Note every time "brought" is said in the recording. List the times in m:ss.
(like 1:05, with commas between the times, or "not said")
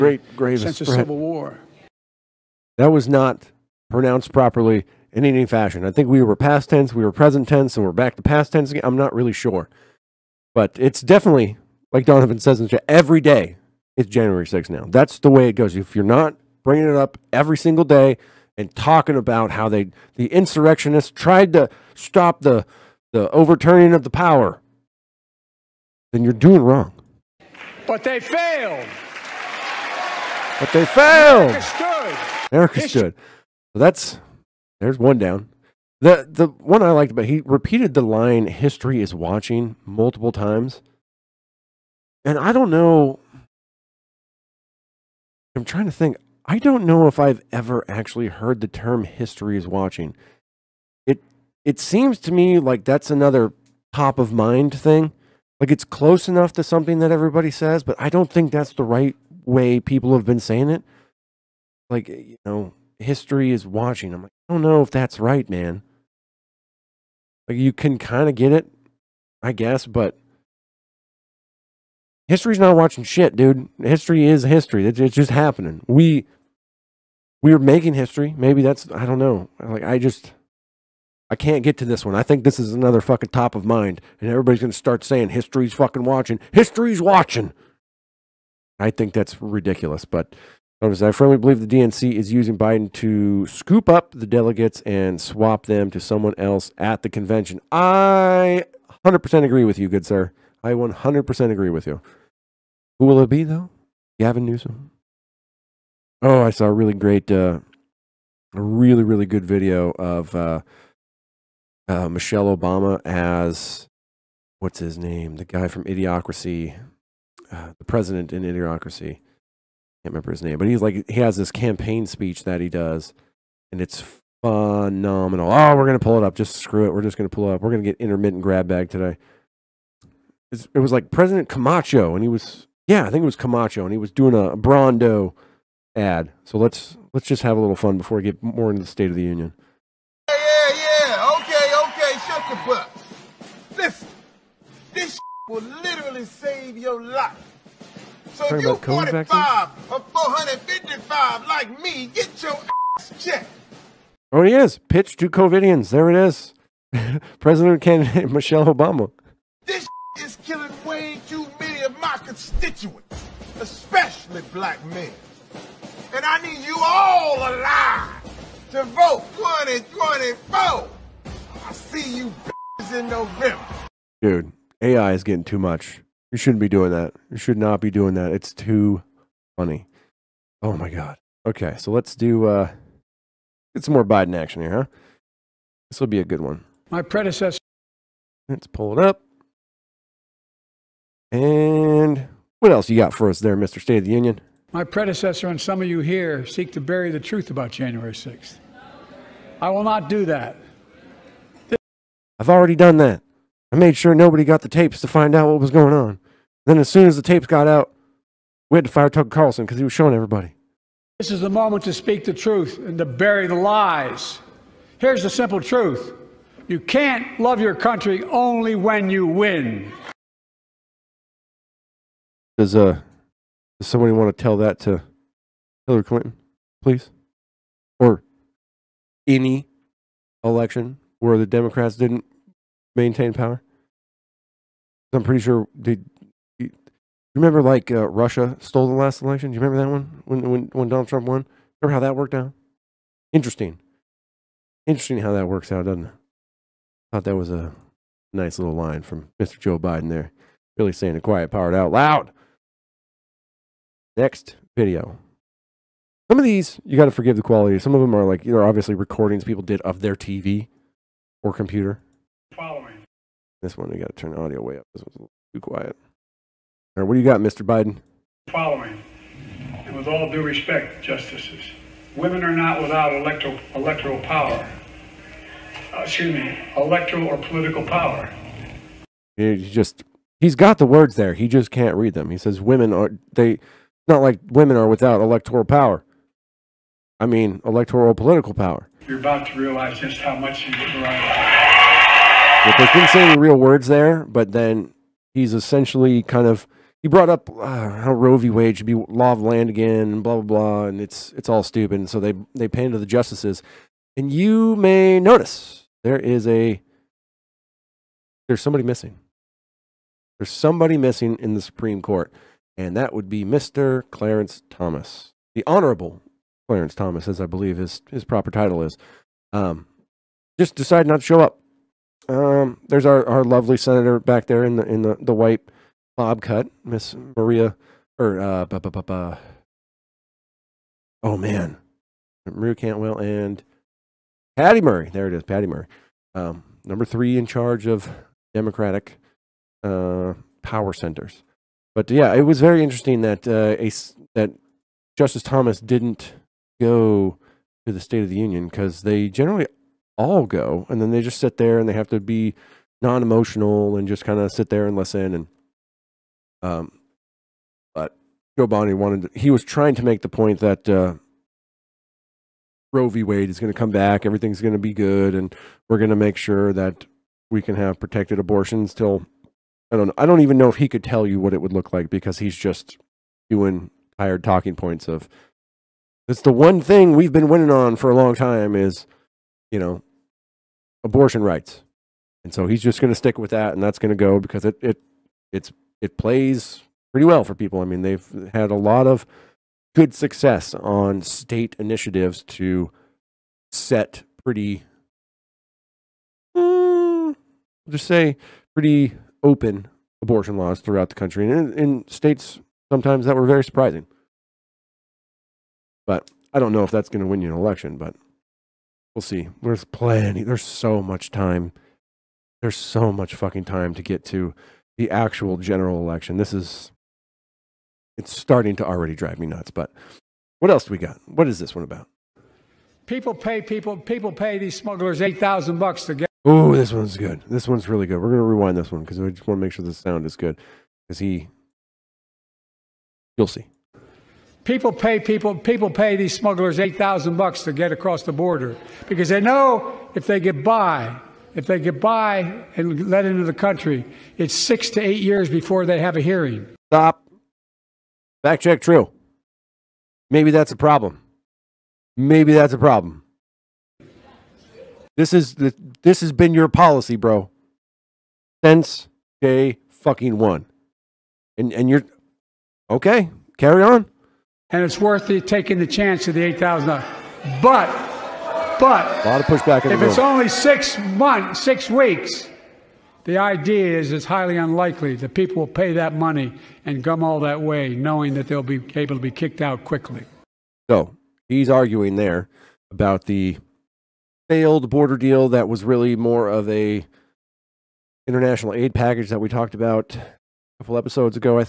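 4:57.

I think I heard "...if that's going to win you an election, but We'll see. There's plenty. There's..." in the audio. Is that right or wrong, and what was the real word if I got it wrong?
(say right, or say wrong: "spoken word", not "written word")
right.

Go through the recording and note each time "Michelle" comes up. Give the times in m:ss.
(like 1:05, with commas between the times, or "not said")
1:52, 2:38.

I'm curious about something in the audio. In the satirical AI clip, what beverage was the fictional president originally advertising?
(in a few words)
Brawndo.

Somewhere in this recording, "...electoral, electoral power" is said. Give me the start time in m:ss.
4:33.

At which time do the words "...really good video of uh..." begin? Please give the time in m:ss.
1:49.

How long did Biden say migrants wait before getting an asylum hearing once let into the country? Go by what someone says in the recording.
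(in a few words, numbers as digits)
6 to 8 years.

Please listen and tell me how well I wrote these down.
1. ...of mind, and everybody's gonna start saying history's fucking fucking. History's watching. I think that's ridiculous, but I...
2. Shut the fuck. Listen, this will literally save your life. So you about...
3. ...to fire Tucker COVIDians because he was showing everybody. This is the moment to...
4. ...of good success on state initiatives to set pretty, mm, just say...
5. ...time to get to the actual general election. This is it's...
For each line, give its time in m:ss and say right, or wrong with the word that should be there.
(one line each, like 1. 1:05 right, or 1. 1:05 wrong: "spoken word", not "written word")
1. 1:23 wrong: "watching", not "fucking"
2. 2:22 right
3. 3:28 wrong: "Carlson", not "COVIDians"
4. 6:29 right
5. 6:53 right.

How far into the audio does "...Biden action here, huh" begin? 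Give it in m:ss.
3:04.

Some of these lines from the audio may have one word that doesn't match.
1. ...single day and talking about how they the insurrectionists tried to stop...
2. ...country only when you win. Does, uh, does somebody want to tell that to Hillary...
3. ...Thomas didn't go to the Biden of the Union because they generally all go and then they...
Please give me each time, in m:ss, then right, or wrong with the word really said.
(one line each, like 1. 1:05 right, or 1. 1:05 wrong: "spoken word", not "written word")
1. 0:17 right
2. 3:37 right
3. 5:45 wrong: "State", not "Biden".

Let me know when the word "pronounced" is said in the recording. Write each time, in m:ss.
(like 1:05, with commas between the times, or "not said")
0:03.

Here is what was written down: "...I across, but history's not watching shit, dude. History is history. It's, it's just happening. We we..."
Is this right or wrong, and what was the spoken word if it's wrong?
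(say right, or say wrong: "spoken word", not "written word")
wrong: "guess", not "across".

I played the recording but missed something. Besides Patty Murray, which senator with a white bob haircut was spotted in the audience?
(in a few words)
Maria Cantwell.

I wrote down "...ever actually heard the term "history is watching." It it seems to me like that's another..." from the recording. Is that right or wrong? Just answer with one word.
right.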